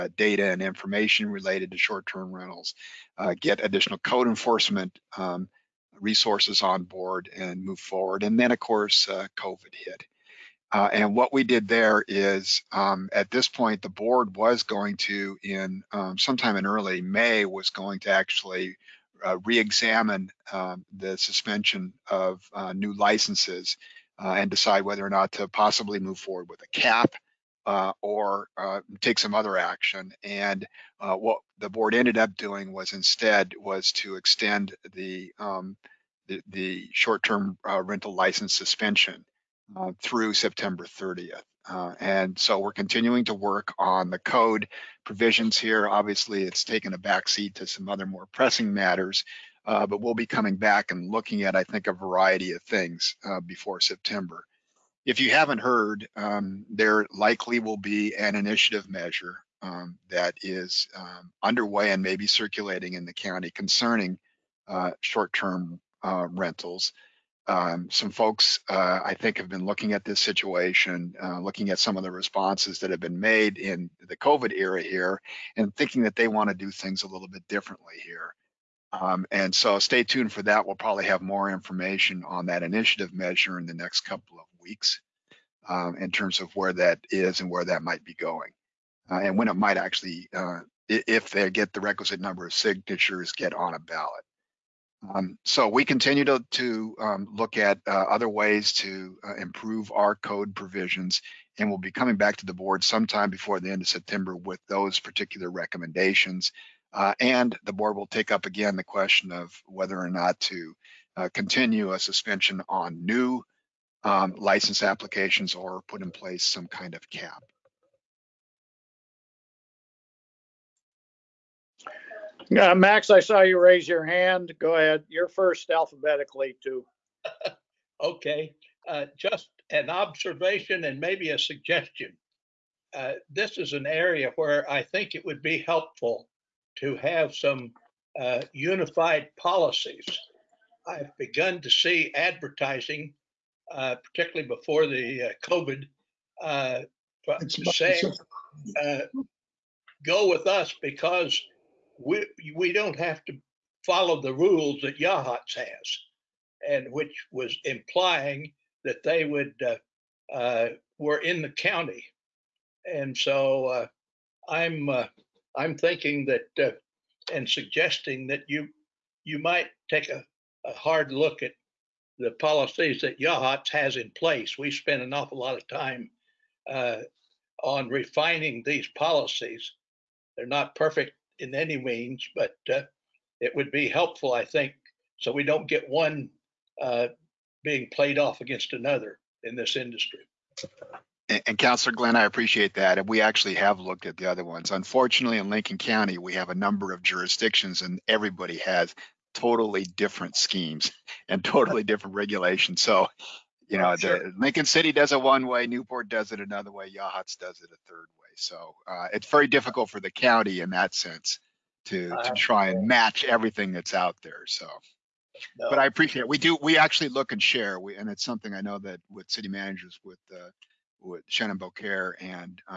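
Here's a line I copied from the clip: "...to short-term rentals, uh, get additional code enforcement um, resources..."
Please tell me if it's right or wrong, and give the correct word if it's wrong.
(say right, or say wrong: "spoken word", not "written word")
right.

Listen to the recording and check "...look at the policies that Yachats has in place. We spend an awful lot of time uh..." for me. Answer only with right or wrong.
right.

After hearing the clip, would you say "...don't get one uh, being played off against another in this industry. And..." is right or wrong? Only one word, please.
right.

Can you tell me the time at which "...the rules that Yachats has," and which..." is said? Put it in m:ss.
2:34.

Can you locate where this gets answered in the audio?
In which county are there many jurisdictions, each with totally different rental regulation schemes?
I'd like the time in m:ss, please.
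3:15.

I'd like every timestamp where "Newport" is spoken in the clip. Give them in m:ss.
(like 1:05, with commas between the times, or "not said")
3:25.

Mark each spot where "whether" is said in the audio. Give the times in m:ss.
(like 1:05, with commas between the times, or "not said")
0:24, 1:49.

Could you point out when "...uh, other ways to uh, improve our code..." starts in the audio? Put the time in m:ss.
1:37.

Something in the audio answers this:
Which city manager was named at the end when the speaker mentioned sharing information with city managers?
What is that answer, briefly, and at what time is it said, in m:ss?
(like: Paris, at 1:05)
Shannon Beaucaire, at 3:41.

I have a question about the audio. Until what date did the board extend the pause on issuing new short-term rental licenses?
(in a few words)
September 30th.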